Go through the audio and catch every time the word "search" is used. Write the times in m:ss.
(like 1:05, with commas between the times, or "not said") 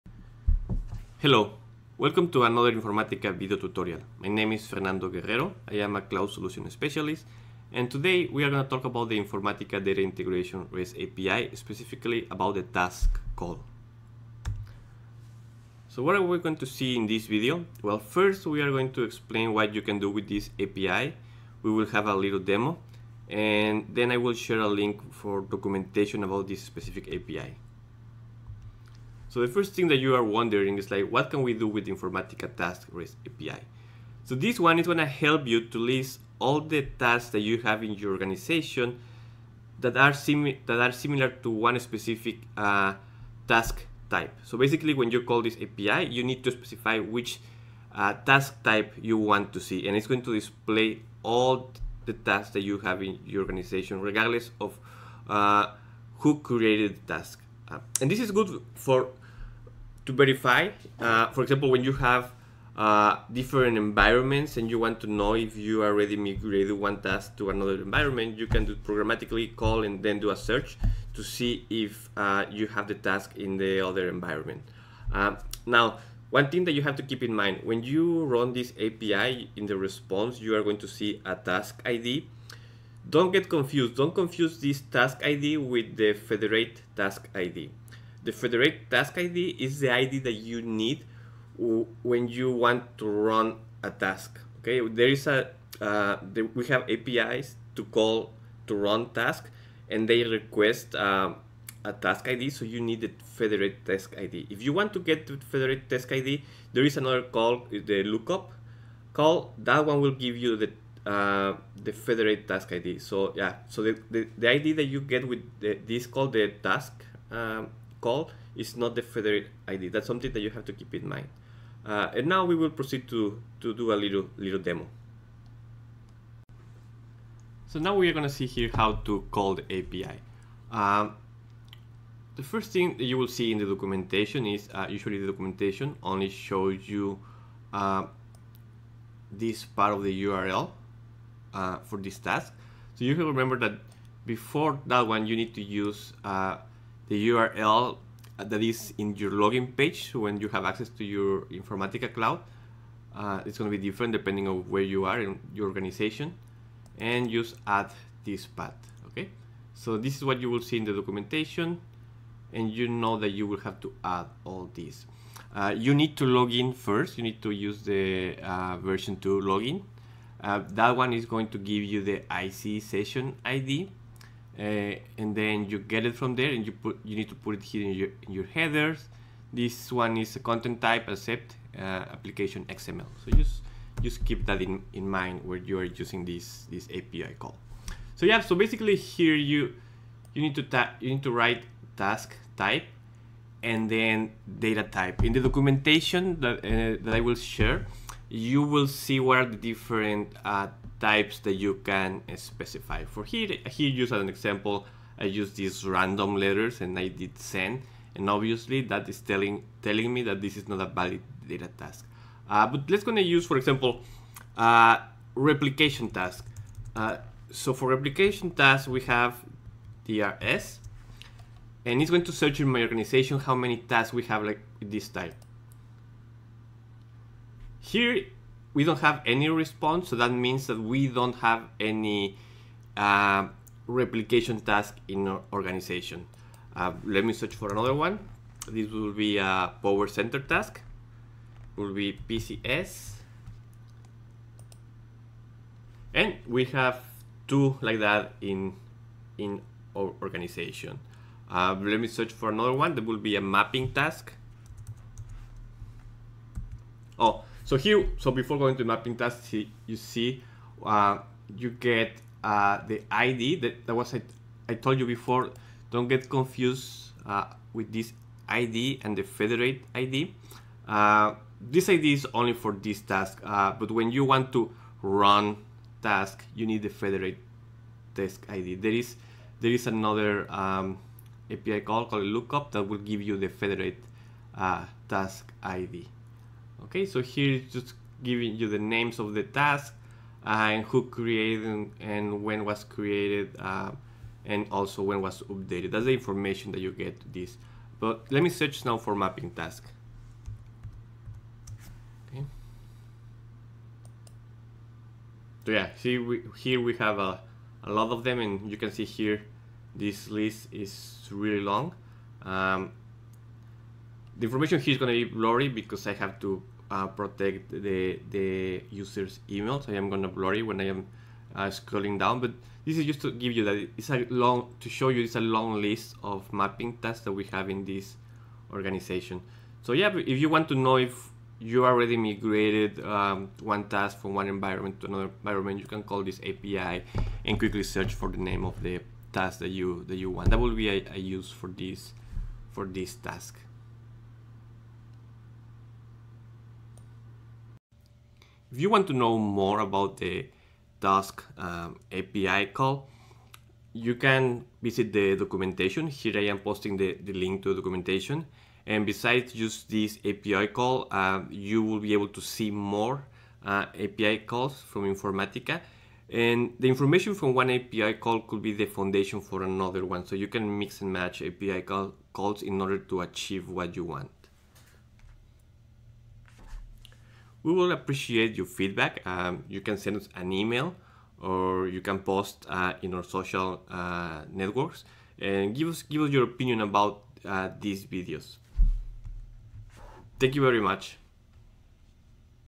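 1:10, 3:42, 3:57, 4:12, 4:58, 5:37.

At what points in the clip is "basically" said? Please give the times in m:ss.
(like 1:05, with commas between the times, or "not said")
0:44, 3:08.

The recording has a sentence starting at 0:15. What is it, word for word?
So what are we going to see in this video?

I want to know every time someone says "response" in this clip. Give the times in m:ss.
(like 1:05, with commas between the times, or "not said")
1:19, 3:49.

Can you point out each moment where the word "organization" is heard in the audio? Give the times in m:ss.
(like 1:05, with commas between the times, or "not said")
0:38, 0:53, 2:35, 3:42, 3:55, 4:10, 5:28.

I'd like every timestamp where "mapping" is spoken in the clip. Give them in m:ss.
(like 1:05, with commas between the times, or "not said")
4:13, 4:18, 4:59, 5:26.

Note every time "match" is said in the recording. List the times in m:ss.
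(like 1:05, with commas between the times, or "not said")
6:11.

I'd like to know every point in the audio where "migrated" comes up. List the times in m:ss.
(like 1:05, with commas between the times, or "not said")
1:06, 5:32.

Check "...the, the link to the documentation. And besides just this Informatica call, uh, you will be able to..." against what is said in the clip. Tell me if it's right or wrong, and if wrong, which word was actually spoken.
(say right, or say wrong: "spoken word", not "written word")
wrong: "API", not "Informatica".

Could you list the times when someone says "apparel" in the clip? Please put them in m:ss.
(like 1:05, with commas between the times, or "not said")
not said.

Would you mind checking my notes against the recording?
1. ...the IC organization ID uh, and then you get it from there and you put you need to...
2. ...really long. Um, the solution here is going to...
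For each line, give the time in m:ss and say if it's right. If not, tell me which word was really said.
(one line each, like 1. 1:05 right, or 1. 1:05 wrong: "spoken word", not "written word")
1. 2:52 wrong: "session", not "organization"
2. 5:11 wrong: "information", not "solution".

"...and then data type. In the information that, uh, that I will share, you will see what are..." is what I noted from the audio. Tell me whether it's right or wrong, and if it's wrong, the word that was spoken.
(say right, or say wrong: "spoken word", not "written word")
wrong: "documentation", not "information".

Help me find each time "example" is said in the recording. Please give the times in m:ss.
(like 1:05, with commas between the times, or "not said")
1:01, 3:24, 3:33.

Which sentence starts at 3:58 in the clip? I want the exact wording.
This will be a PowerCenter task.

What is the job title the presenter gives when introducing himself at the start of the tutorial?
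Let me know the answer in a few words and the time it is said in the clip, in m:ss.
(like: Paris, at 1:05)
cloud solution specialist, at 0:06.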